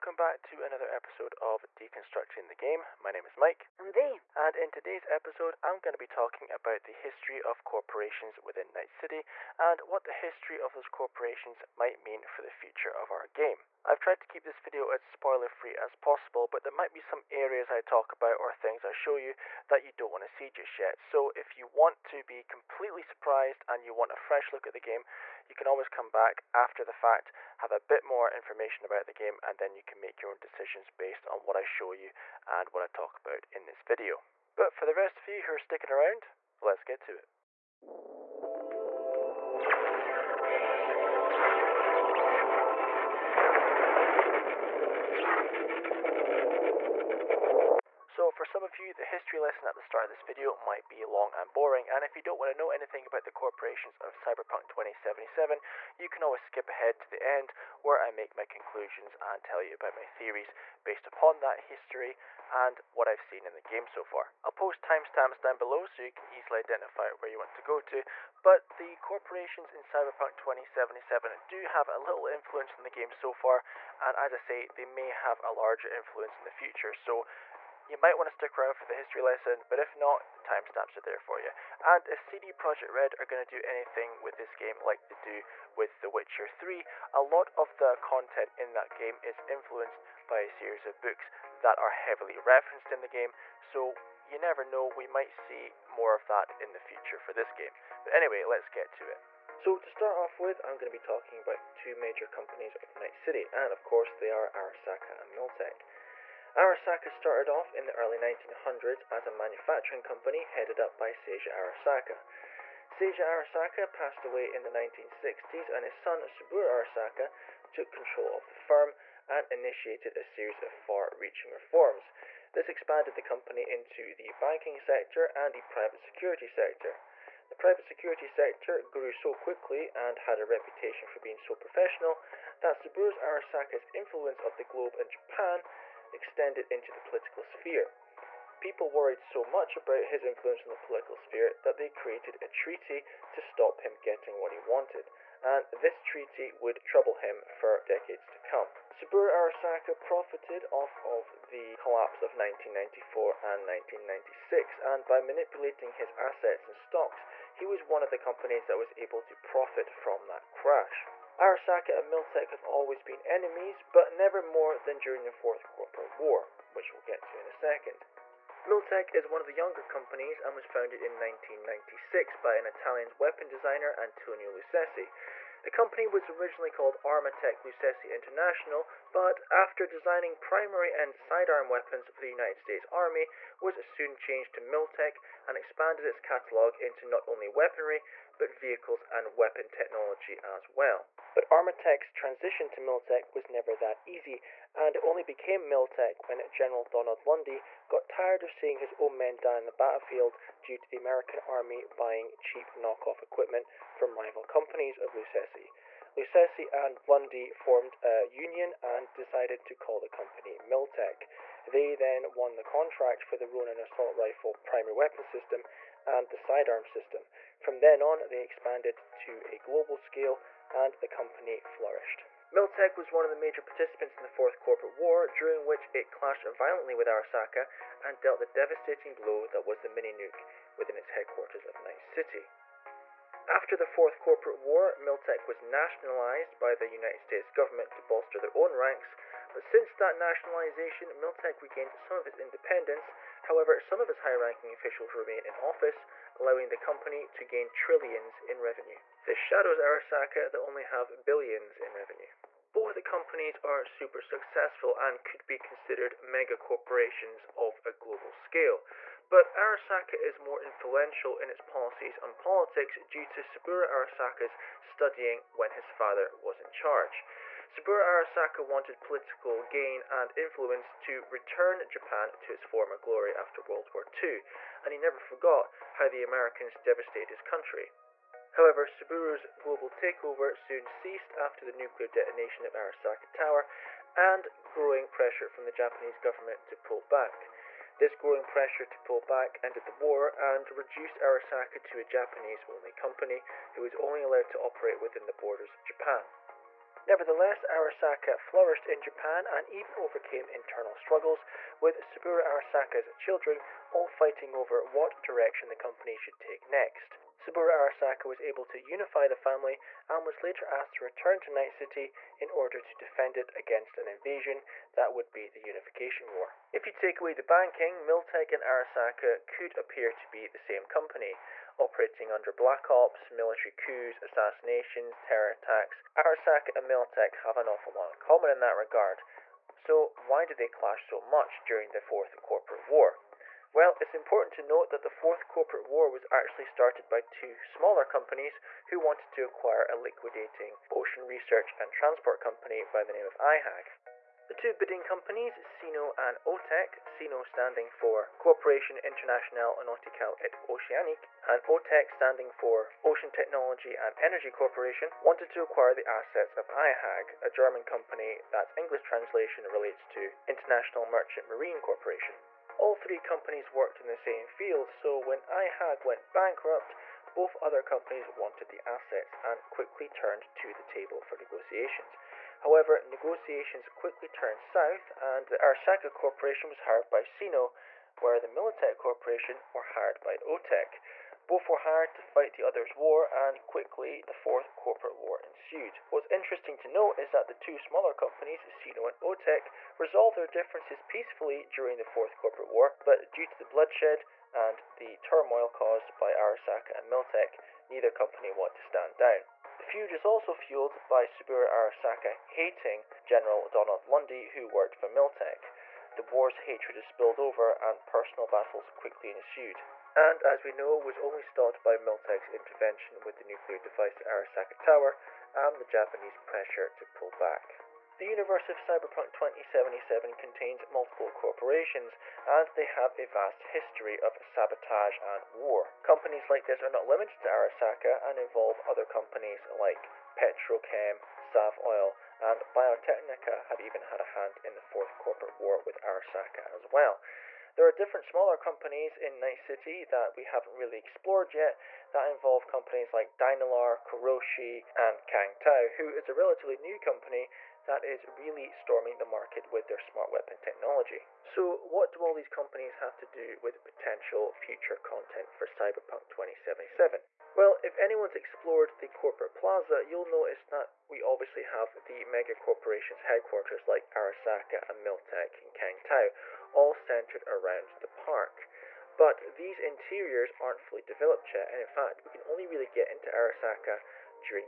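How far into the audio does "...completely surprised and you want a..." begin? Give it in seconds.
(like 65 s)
22 s.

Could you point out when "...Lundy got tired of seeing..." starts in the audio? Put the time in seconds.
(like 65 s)
197 s.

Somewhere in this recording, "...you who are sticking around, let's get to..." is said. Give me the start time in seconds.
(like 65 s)
35 s.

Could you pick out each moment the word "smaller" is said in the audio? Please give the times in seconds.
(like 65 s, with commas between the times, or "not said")
337 s, 387 s, 438 s.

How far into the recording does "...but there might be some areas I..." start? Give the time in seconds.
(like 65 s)
16 s.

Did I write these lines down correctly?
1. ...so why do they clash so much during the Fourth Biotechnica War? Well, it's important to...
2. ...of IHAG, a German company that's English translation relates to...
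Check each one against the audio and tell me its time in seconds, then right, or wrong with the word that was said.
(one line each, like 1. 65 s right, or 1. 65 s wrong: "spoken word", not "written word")
1. 329 s wrong: "Corporate", not "Biotechnica"
2. 356 s right.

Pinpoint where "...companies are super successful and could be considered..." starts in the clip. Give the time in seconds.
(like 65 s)
253 s.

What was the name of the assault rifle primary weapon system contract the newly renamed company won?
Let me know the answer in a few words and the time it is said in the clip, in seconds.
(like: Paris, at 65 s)
Ronin, at 213 s.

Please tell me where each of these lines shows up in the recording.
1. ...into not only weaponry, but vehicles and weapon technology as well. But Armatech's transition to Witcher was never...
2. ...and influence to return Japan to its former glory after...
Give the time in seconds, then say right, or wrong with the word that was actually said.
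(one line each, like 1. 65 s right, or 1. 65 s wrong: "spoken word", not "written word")
1. 186 s wrong: "Miltech", not "Witcher"
2. 270 s right.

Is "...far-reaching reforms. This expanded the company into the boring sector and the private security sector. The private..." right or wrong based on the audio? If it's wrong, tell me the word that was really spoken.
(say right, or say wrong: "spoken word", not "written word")
wrong: "banking", not "boring".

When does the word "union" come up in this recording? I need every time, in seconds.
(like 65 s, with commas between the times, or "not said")
208 s.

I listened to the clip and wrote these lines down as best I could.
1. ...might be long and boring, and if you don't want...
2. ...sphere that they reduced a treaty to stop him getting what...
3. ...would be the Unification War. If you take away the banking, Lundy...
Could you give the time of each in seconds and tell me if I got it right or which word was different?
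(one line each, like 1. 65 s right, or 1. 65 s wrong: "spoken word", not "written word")
1. 50 s right
2. 141 s wrong: "created", not "reduced"
3. 315 s wrong: "Miltech", not "Lundy".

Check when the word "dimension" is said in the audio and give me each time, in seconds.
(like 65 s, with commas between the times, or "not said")
not said.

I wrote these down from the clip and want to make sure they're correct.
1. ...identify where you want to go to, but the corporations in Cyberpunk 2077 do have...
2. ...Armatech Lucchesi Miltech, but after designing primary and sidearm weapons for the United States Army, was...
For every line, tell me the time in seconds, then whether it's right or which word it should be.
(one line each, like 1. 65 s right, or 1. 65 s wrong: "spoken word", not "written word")
1. 66 s right
2. 177 s wrong: "International", not "Miltech".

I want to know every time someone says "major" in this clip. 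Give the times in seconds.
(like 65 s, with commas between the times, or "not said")
101 s, 223 s.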